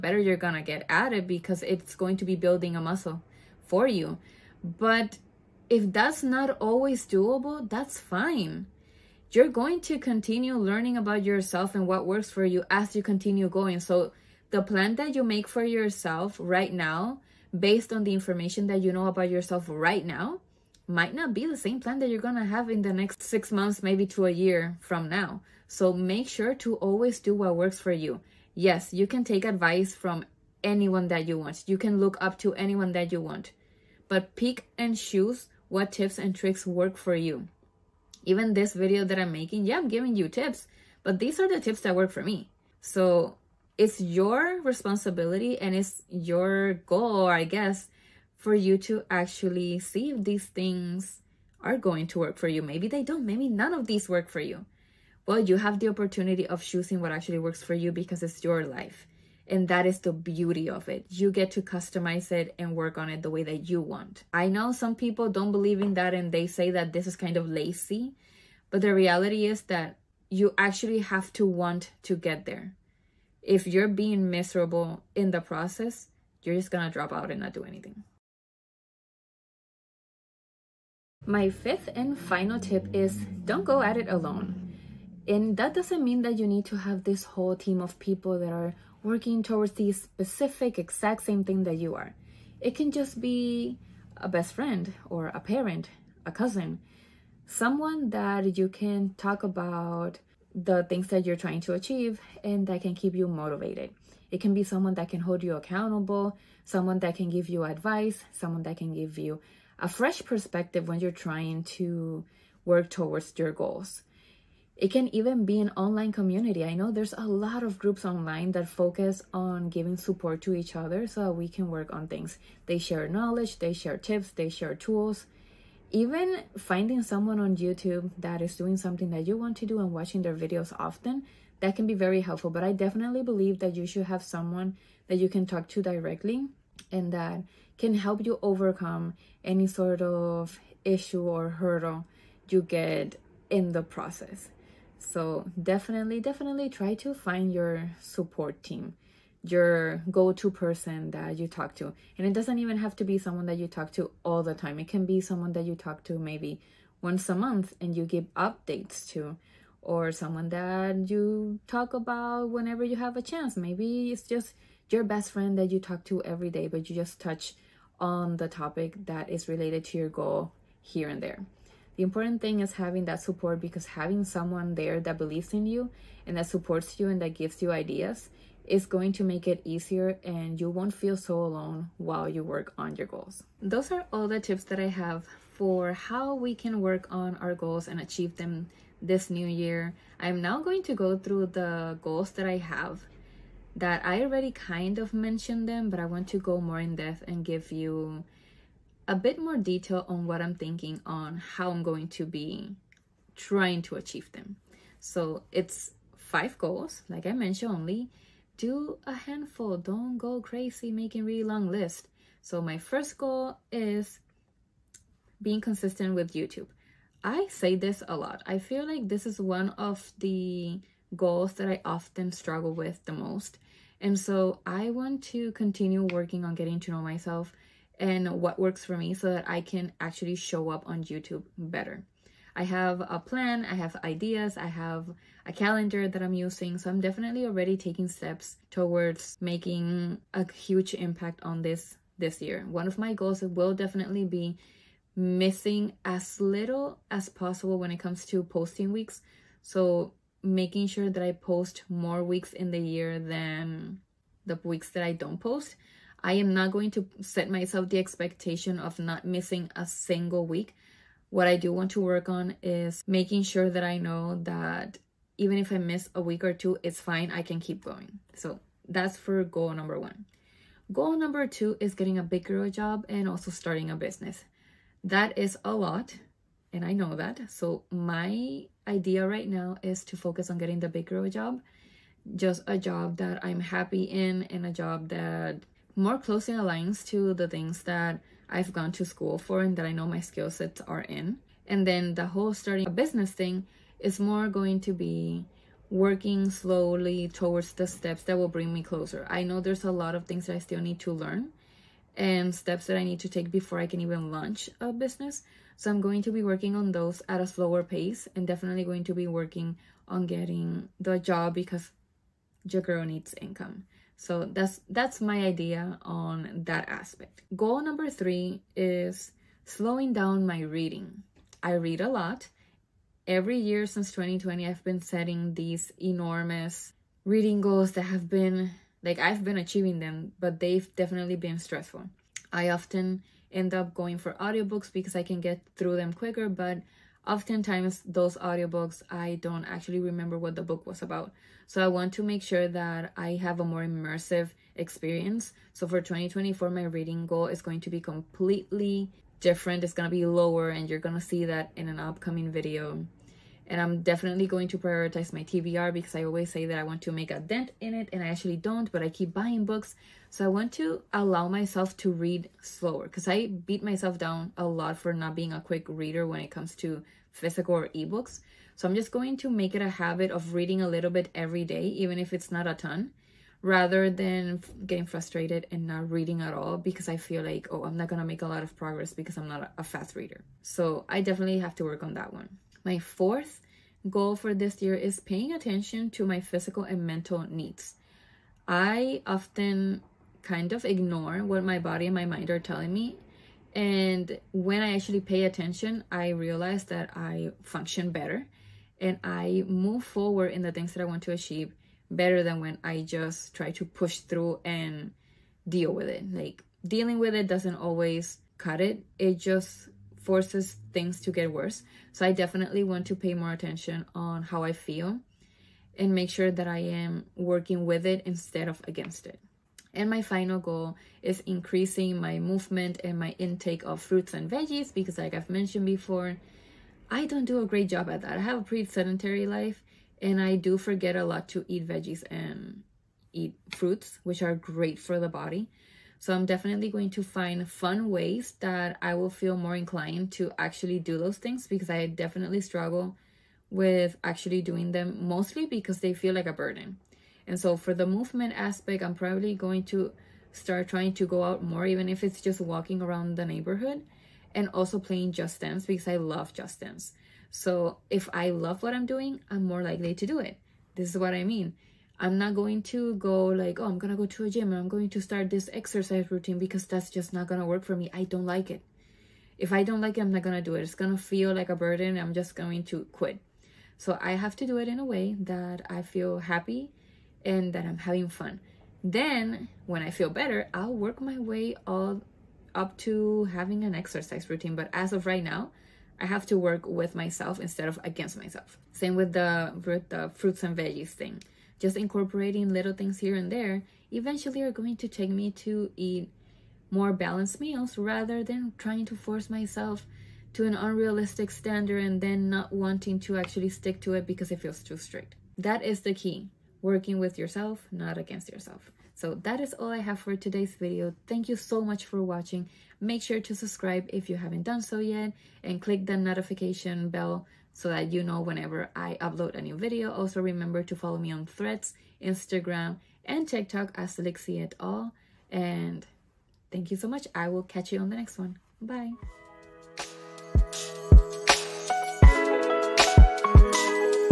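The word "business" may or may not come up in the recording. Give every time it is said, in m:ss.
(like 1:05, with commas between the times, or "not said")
4:33, 4:52, 5:04.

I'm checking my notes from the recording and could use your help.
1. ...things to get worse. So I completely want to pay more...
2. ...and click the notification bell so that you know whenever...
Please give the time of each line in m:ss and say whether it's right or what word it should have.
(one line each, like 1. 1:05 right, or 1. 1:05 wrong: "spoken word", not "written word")
1. 6:50 wrong: "definitely", not "completely"
2. 8:35 right.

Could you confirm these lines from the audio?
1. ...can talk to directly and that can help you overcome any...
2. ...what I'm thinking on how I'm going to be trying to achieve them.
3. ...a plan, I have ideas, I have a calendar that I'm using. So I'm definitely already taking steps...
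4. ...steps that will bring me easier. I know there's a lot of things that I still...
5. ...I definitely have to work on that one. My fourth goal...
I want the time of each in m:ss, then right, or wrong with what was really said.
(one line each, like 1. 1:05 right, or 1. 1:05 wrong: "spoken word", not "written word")
1. 2:15 right
2. 3:20 right
3. 3:52 right
4. 4:57 wrong: "closer", not "easier"
5. 6:21 right.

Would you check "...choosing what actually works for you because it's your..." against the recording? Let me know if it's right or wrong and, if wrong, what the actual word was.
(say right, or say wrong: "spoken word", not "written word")
right.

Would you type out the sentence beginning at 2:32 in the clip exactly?
And it doesn't even have to be someone that you talk to all the time.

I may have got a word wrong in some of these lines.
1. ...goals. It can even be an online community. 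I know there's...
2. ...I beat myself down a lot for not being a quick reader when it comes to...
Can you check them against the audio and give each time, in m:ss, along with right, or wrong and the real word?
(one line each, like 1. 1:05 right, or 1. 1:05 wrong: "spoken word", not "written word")
1. 1:53 right
2. 6:03 right.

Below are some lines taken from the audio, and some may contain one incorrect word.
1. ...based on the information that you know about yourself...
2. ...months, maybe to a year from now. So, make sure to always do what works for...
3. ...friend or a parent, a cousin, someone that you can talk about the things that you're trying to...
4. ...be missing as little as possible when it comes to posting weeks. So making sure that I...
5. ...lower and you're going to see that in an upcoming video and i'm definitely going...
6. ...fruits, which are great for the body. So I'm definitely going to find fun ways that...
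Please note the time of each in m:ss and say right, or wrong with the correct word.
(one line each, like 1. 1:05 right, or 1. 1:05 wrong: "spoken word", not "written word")
1. 0:17 right
2. 0:23 right
3. 1:34 right
4. 4:04 right
5. 5:50 right
6. 7:13 right.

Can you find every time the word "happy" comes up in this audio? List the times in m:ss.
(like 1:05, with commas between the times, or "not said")
4:43, 7:56.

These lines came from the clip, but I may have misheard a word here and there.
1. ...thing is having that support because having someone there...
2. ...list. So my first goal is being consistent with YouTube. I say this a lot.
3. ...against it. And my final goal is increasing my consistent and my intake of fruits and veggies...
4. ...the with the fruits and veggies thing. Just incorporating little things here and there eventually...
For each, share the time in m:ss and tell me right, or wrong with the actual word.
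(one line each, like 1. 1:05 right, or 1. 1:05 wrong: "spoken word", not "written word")
1. 2:52 right
2. 3:31 right
3. 6:58 wrong: "movement", not "consistent"
4. 8:09 right.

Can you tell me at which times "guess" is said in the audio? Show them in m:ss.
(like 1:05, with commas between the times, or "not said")
0:47.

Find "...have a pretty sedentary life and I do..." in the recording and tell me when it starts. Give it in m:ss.
7:08.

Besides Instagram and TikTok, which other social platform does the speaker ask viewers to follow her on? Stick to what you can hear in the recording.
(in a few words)
Threads.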